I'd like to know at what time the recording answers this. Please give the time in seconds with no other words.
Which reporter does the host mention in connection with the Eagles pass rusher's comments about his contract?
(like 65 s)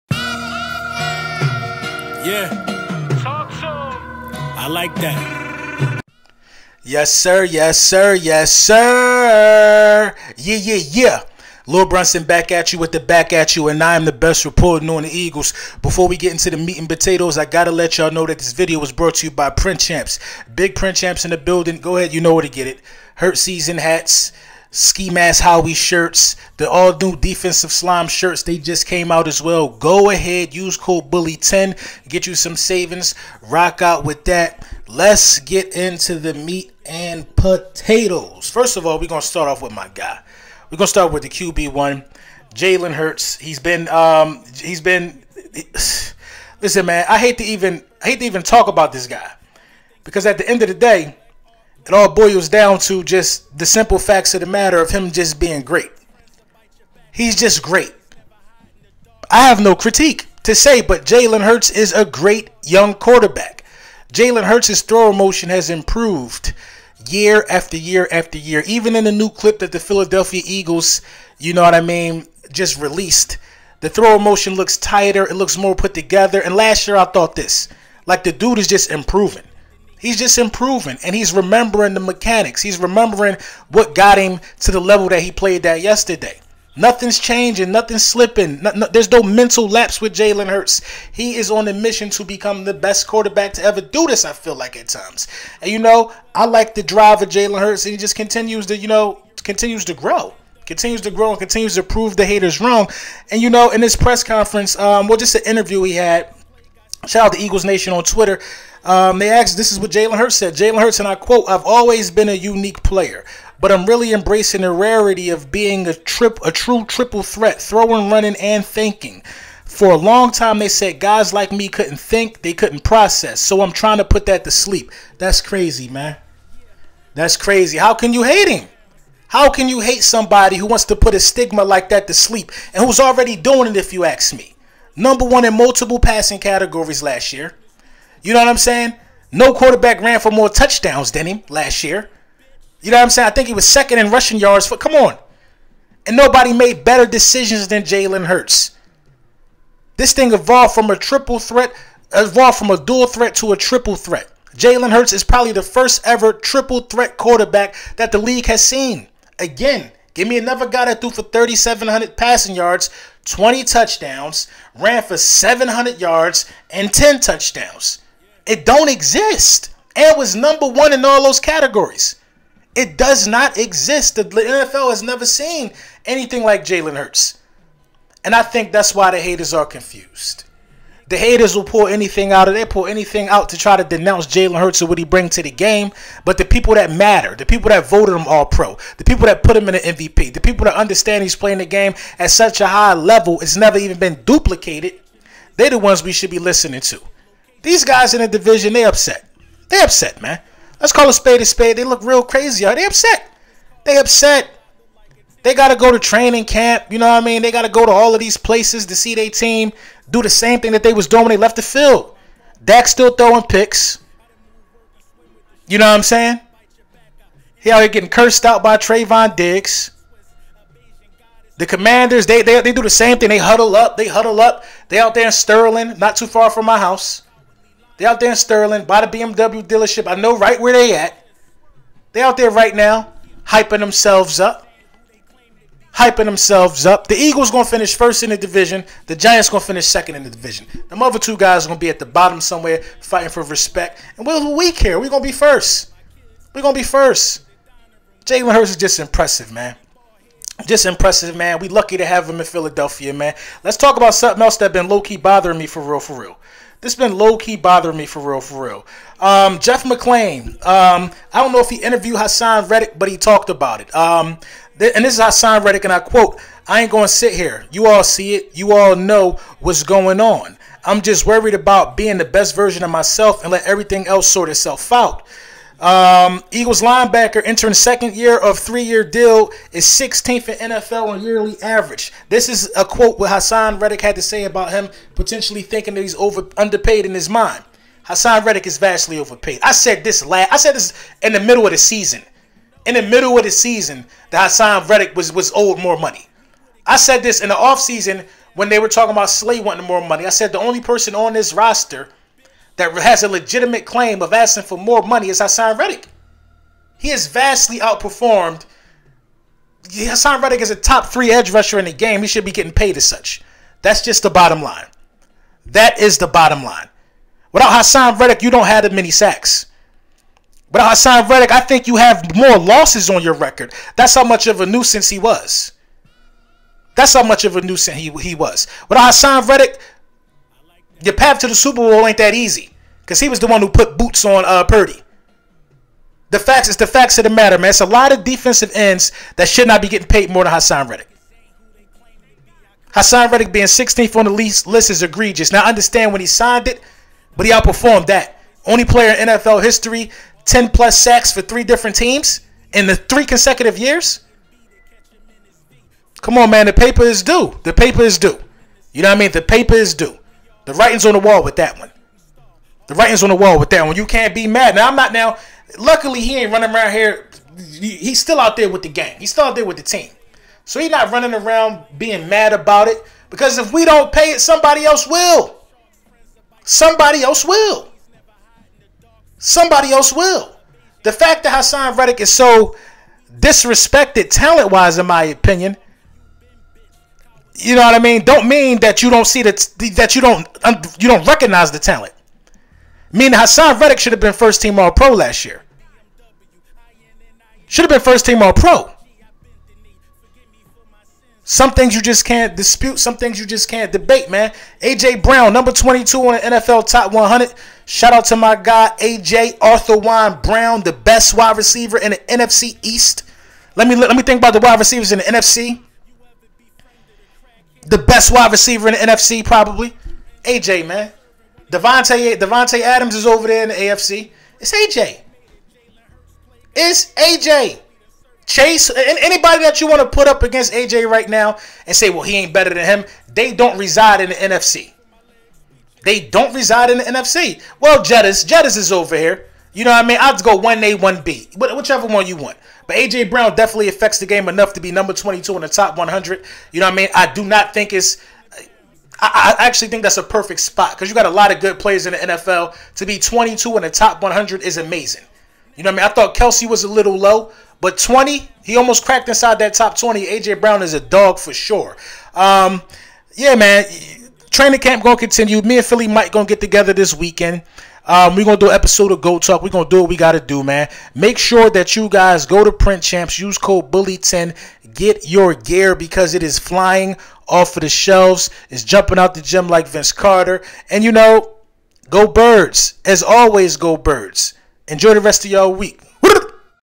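259 s.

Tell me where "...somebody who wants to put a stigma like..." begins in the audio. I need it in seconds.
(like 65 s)
130 s.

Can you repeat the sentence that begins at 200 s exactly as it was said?
Let's call a spade a spade.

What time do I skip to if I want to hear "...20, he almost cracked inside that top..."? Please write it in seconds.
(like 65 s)
457 s.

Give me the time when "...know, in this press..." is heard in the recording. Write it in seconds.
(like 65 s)
103 s.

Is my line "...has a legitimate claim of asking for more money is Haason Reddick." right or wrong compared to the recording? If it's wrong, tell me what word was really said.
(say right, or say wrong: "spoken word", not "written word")
right.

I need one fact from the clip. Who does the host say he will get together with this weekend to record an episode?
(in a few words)
Philly Mike.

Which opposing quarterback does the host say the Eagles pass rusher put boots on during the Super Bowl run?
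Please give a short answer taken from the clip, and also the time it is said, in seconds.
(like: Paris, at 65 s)
Purdy, at 334 s.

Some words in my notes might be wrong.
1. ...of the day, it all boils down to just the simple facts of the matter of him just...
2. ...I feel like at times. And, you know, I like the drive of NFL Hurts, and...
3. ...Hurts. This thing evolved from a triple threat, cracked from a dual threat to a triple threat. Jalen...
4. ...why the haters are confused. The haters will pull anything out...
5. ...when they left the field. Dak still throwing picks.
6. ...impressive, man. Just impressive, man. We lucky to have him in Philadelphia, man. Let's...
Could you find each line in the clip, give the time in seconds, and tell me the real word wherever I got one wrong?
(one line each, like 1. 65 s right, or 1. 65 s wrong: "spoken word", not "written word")
1. 50 s right
2. 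94 s wrong: "Jalen", not "NFL"
3. 148 s wrong: "evolved", not "cracked"
4. 178 s right
5. 211 s right
6. 248 s right.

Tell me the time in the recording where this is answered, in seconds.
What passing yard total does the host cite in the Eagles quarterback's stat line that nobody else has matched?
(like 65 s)
161 s.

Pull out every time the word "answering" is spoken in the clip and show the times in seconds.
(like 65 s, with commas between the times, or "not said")
not said.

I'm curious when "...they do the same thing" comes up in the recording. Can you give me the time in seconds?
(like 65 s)
222 s.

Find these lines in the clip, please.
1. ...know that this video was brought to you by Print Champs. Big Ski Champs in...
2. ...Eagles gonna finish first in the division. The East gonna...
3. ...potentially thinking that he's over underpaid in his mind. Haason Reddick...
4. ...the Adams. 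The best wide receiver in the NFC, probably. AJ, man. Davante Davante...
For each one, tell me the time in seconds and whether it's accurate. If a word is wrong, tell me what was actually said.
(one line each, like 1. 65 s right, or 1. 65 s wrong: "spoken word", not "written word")
1. 18 s wrong: "Print", not "Ski"
2. 237 s wrong: "Giants", not "East"
3. 285 s right
4. 415 s wrong: "NFC", not "Adams".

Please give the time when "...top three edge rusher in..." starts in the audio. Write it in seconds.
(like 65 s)
310 s.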